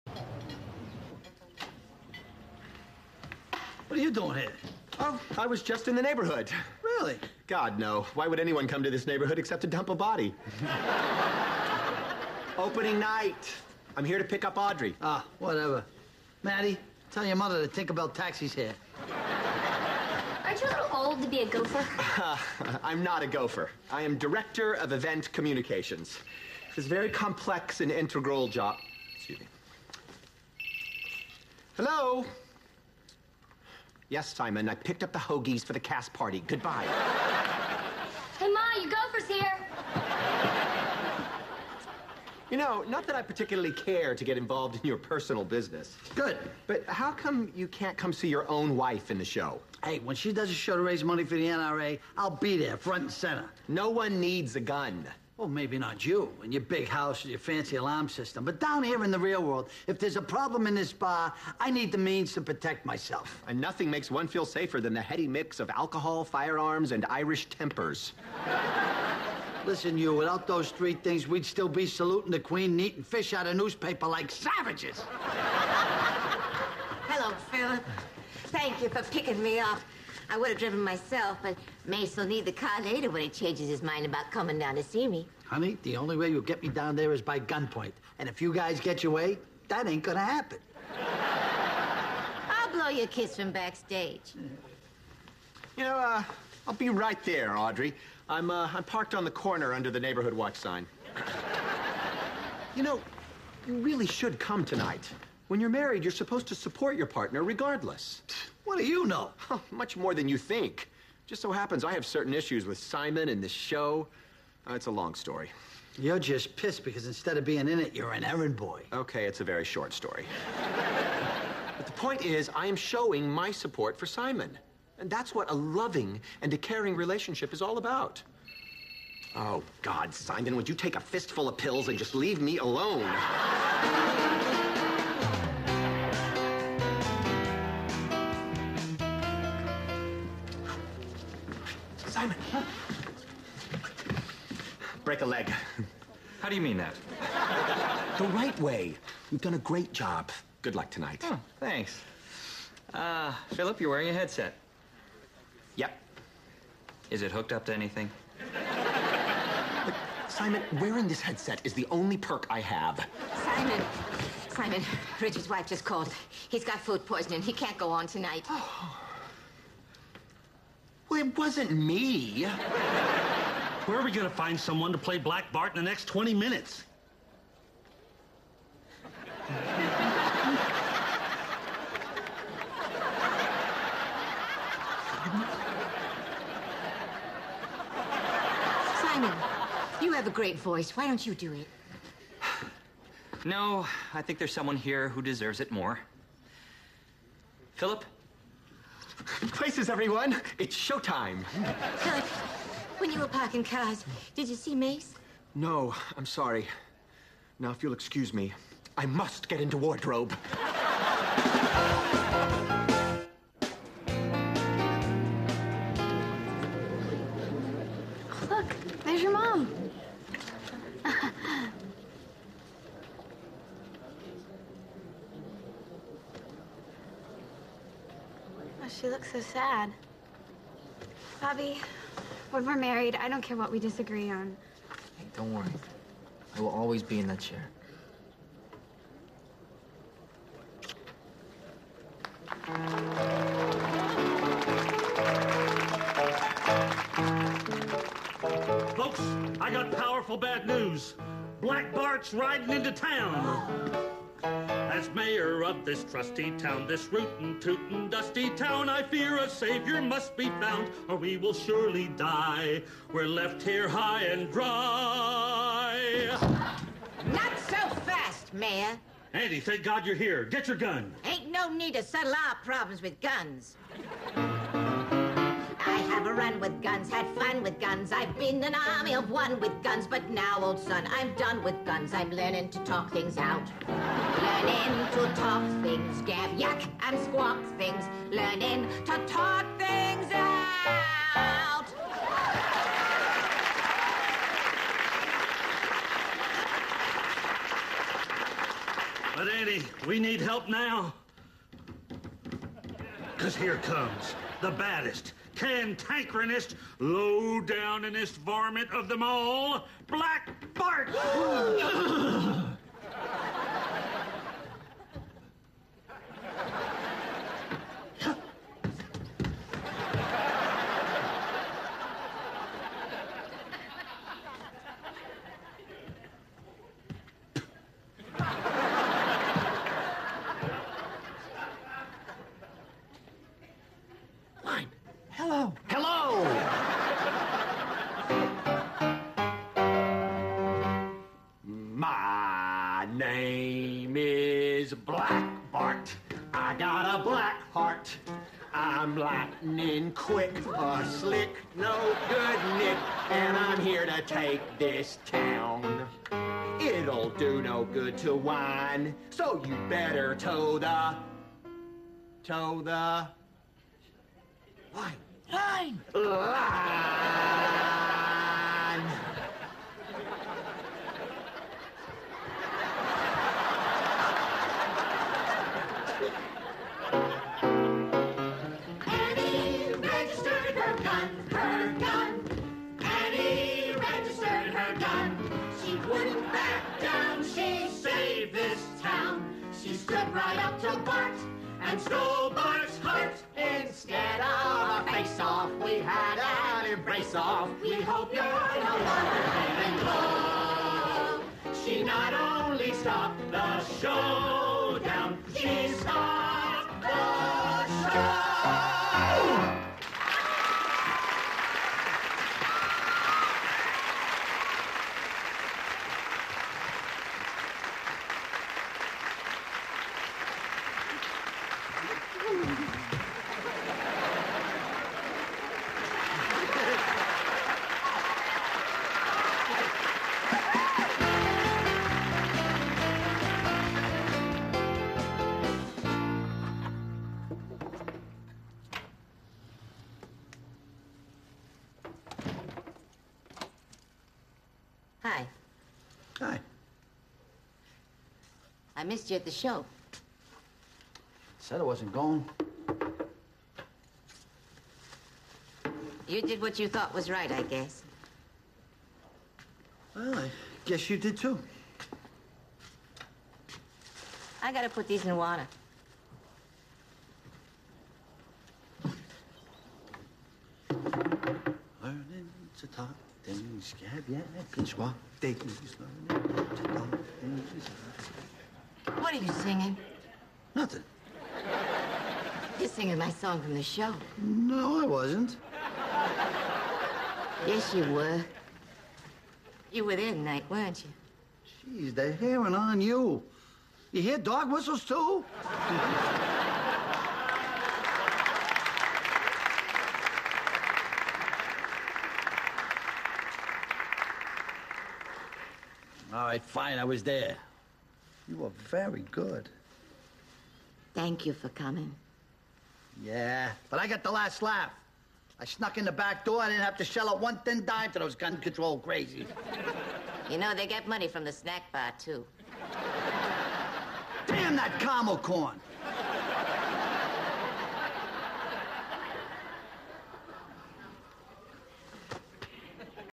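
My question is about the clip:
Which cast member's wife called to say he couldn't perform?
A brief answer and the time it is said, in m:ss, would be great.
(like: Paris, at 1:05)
Richard, at 2:45.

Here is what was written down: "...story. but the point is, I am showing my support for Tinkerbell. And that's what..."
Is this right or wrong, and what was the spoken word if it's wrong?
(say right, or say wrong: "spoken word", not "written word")
wrong: "Simon", not "Tinkerbell".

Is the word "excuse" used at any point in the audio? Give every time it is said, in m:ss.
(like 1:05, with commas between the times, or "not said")
0:29, 3:27.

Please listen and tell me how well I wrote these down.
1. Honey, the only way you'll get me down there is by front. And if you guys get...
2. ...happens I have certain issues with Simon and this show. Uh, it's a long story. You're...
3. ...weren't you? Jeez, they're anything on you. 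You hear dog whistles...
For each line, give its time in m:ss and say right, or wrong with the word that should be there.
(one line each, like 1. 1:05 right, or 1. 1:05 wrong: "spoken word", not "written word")
1. 1:25 wrong: "gunpoint", not "front"
2. 1:51 right
3. 8:10 wrong: "hearing", not "anything".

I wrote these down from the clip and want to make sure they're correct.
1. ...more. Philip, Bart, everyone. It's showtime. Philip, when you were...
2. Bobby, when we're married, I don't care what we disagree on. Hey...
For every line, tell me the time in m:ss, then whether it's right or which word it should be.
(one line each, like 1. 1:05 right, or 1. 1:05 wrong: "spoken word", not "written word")
1. 3:15 wrong: "Places", not "Bart"
2. 3:51 right.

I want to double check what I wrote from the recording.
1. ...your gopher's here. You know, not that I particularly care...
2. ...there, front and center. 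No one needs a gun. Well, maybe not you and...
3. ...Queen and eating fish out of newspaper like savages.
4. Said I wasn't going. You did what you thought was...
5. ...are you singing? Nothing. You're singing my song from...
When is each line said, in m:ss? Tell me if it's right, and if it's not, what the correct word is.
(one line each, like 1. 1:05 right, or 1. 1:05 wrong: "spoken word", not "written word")
1. 0:38 right
2. 0:52 right
3. 1:12 right
4. 7:31 right
5. 7:59 right.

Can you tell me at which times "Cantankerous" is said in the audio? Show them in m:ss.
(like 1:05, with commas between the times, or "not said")
5:05.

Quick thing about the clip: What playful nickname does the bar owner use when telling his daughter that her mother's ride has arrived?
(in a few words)
Tinkerbell Taxi.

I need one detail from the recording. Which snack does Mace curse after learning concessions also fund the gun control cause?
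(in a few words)
caramel corn.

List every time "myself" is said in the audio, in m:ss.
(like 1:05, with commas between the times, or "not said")
1:02, 1:20.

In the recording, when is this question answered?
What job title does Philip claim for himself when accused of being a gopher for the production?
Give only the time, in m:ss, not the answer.
0:24.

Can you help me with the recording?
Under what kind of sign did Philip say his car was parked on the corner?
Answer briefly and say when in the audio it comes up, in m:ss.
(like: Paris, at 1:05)
neighborhood watch sign, at 1:39.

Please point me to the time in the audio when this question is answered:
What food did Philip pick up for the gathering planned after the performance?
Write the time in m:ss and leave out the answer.
0:35.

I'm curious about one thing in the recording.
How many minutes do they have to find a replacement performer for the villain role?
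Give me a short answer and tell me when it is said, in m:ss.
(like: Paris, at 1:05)
20, at 2:56.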